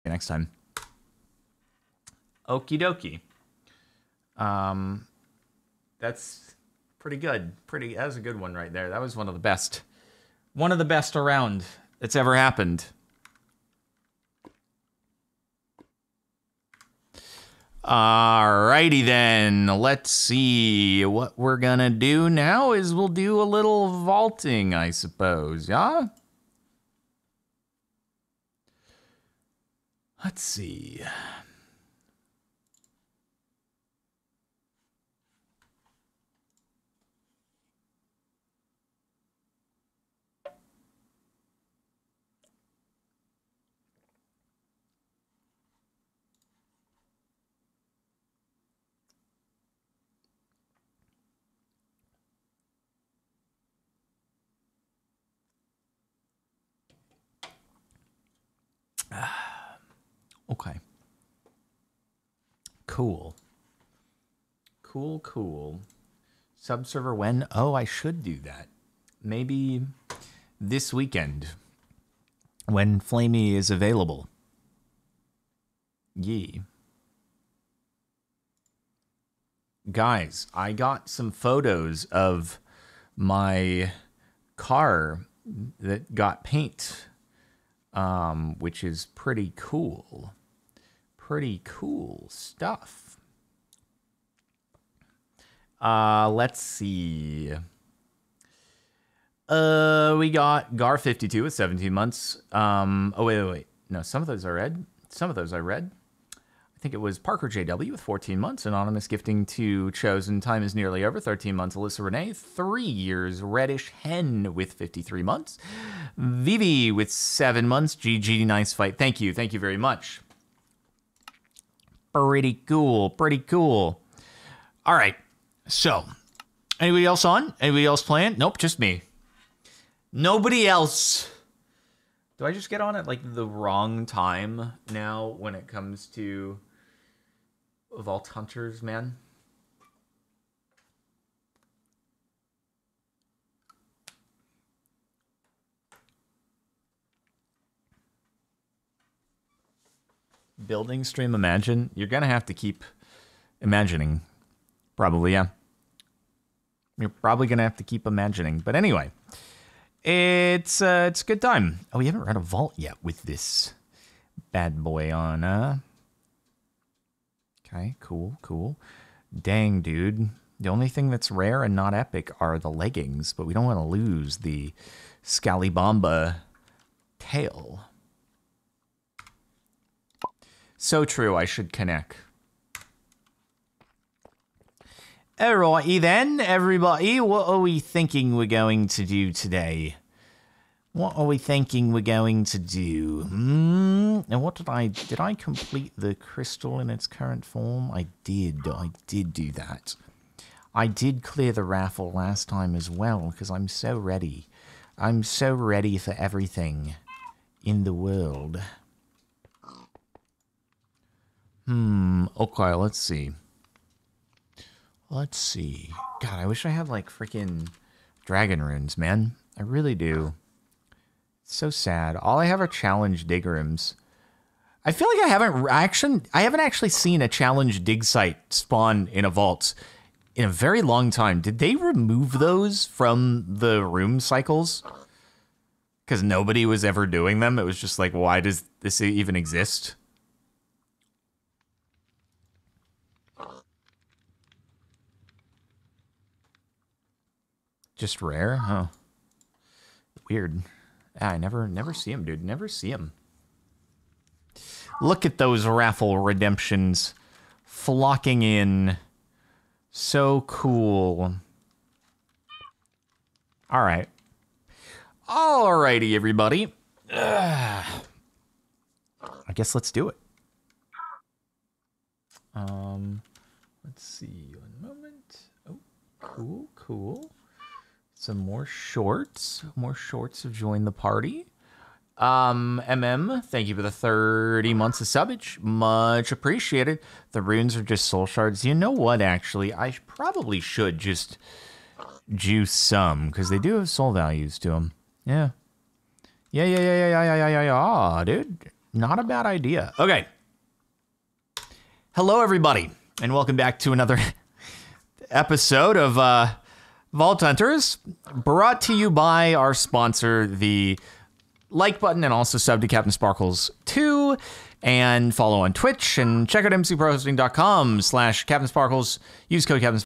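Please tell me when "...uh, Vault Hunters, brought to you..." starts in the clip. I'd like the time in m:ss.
5:06.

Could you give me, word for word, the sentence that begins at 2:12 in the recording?
Do I just get on at like the wrong time now when it comes to Vault Hunters, man?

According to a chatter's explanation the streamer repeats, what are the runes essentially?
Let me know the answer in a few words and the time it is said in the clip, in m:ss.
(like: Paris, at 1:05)
Soul shards, at 4:48.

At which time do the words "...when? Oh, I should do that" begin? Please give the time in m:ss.
1:07.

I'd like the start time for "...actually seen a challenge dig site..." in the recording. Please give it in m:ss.
3:46.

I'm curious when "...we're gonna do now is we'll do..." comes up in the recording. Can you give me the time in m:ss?
0:21.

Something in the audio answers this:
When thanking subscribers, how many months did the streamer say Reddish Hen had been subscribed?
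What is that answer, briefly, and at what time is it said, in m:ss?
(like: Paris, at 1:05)
53 months, at 1:54.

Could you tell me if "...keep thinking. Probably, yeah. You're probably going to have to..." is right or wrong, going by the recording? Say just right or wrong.
wrong.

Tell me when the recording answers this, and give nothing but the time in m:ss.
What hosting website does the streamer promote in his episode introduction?
5:16.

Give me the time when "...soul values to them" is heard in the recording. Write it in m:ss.
4:53.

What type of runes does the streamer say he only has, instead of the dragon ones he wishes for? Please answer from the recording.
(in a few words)
Challenge digrams.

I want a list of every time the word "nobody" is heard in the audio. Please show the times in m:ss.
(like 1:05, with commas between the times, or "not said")
2:10, 3:56.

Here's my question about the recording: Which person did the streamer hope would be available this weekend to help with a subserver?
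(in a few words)
Flamey.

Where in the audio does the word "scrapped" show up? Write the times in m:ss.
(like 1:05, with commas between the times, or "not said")
not said.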